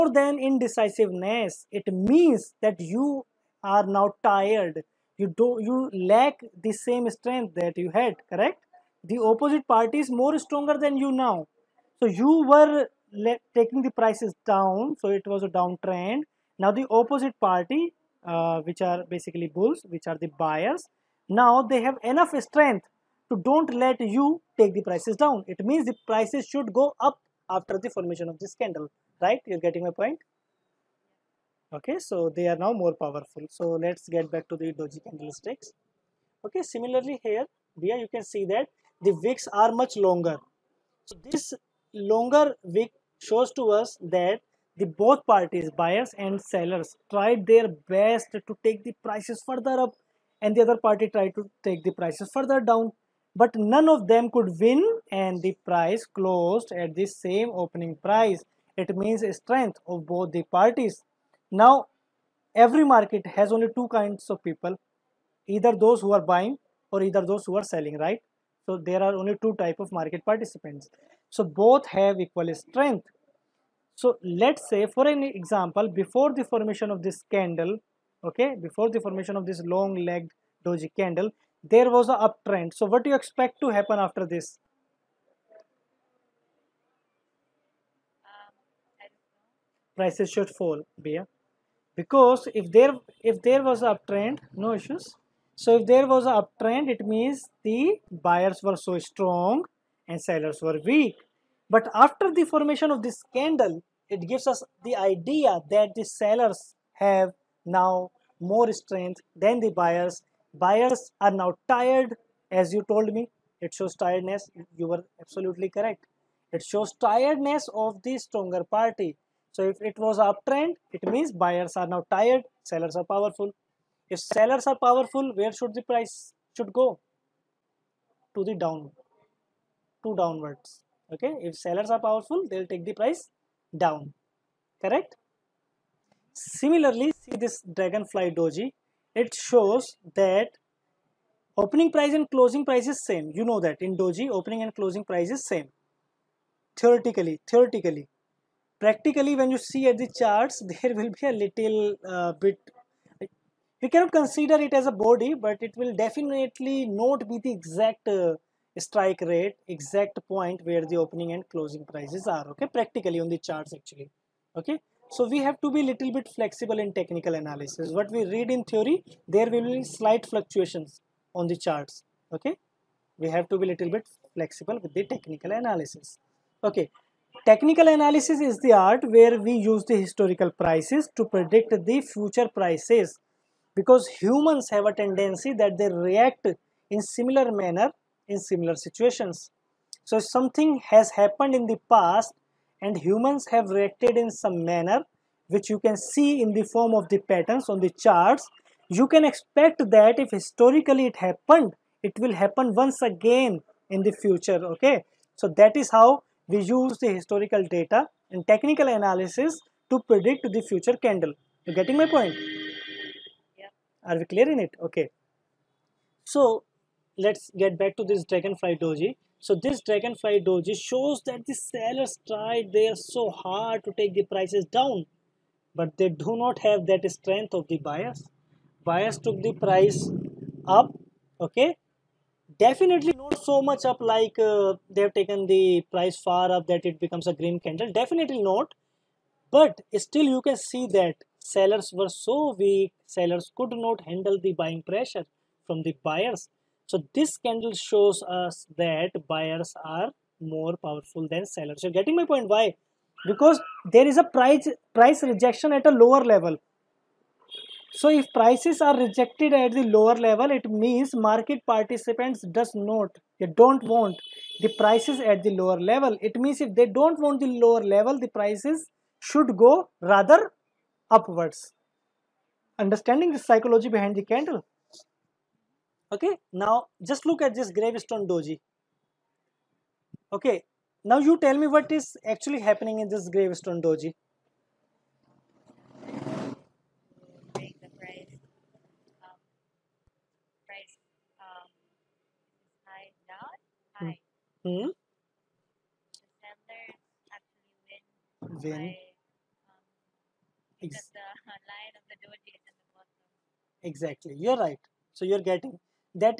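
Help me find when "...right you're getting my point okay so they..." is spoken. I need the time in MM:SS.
00:29.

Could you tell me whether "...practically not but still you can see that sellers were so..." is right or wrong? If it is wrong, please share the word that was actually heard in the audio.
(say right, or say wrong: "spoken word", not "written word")
wrong: "definitely", not "practically".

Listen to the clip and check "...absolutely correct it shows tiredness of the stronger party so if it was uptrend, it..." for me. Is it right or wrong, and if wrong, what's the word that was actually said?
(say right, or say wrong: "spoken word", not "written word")
right.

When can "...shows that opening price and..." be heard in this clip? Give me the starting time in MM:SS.
02:19.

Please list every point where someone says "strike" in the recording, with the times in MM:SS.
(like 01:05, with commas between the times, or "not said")
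02:38.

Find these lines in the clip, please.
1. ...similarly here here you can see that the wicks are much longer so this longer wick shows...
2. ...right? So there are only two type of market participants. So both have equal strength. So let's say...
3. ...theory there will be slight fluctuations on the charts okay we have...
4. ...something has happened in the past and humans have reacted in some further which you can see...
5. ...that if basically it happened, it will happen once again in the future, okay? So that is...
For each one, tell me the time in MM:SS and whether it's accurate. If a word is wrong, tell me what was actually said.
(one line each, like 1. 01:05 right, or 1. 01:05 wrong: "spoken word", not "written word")
1. 00:36 right
2. 01:07 right
3. 02:48 right
4. 03:10 wrong: "manner", not "further"
5. 03:19 wrong: "historically", not "basically".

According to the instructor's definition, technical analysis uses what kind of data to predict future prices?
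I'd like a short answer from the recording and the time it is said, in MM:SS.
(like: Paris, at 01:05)
historical prices, at 02:59.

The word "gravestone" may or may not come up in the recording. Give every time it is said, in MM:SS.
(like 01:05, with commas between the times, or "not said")
04:37, 04:43.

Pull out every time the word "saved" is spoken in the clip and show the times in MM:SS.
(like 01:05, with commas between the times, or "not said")
not said.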